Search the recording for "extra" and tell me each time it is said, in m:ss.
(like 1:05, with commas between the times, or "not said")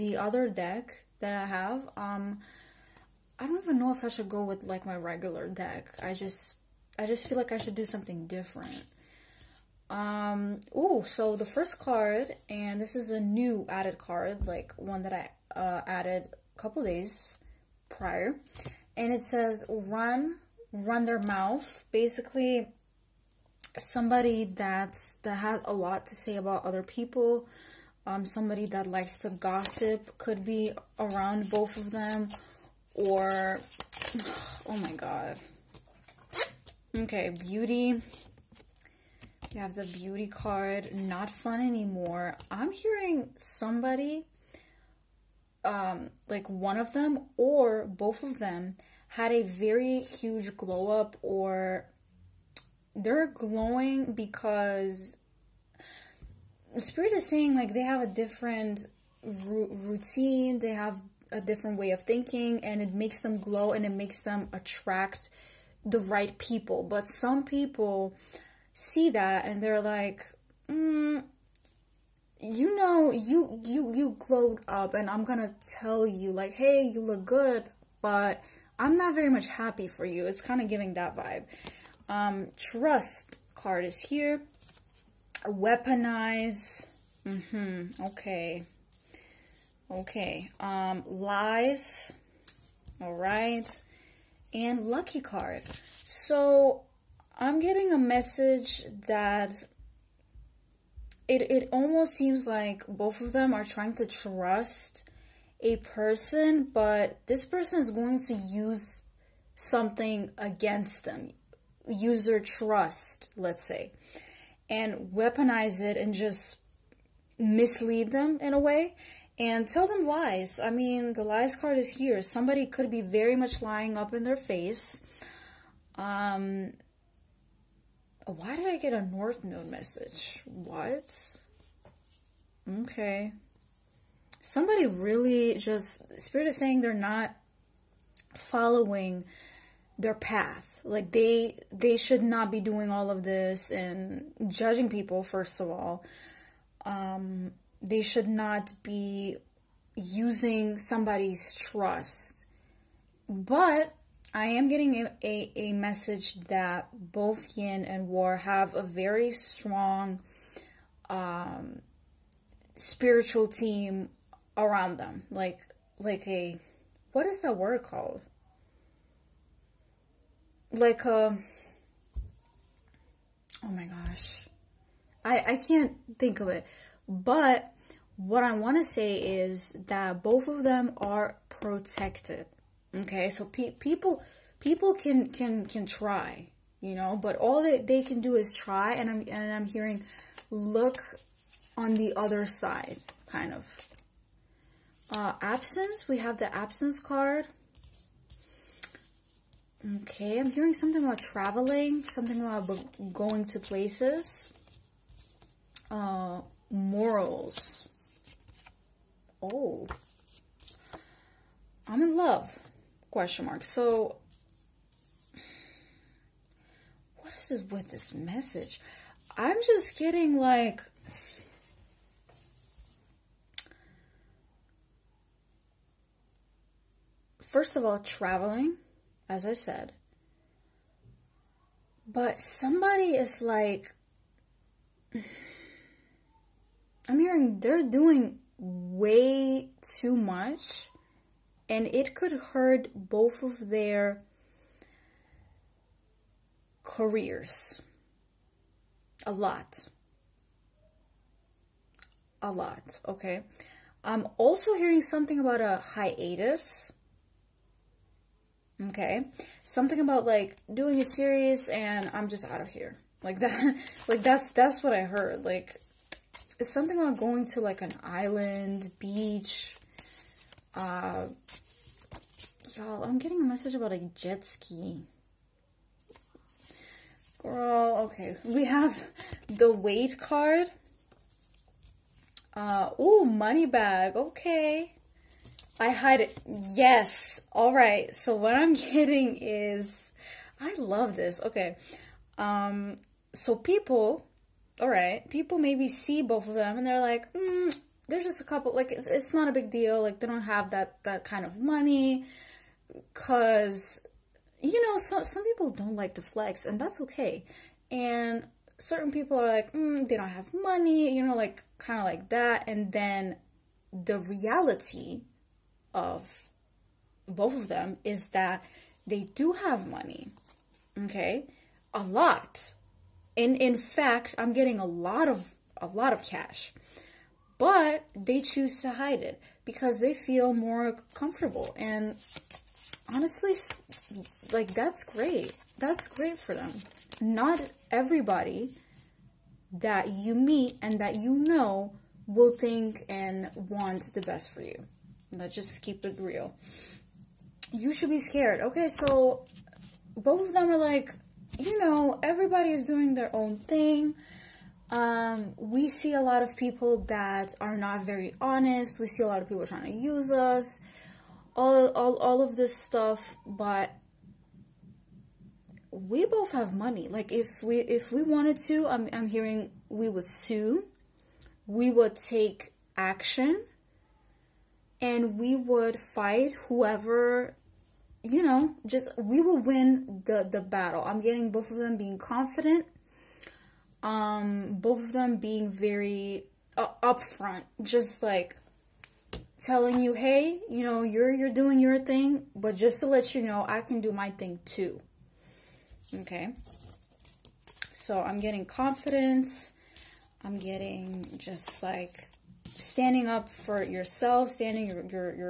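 not said.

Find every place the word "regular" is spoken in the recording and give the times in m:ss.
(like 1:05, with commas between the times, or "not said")
0:04.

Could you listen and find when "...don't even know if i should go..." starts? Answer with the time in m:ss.
0:03.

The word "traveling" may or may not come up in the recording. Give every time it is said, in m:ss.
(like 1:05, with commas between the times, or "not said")
3:21, 3:47.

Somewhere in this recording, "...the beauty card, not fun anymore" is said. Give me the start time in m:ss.
0:39.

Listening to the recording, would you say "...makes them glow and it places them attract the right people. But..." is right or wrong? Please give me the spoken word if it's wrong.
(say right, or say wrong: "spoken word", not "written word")
wrong: "makes", not "places".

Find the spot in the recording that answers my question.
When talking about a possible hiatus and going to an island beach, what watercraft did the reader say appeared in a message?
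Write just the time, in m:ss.
4:34.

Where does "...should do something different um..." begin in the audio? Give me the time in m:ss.
0:07.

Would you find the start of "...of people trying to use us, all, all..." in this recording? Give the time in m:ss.
5:59.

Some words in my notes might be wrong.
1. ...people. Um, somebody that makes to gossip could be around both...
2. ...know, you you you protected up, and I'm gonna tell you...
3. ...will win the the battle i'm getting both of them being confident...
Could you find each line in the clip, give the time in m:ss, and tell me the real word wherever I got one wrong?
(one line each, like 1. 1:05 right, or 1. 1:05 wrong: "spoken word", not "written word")
1. 0:26 wrong: "likes", not "makes"
2. 1:12 wrong: "glowed", not "protected"
3. 6:19 right.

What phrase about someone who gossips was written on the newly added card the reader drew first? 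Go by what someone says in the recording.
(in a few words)
Run their mouth.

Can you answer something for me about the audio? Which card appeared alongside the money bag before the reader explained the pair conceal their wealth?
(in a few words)
Weight.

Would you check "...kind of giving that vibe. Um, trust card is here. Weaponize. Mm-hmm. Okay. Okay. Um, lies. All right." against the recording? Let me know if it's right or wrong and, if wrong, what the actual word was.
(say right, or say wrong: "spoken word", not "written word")
right.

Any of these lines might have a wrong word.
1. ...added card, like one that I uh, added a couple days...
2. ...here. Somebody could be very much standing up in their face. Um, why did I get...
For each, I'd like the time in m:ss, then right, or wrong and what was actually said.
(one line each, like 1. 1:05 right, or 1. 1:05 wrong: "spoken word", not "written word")
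1. 0:13 right
2. 2:01 wrong: "lying", not "standing".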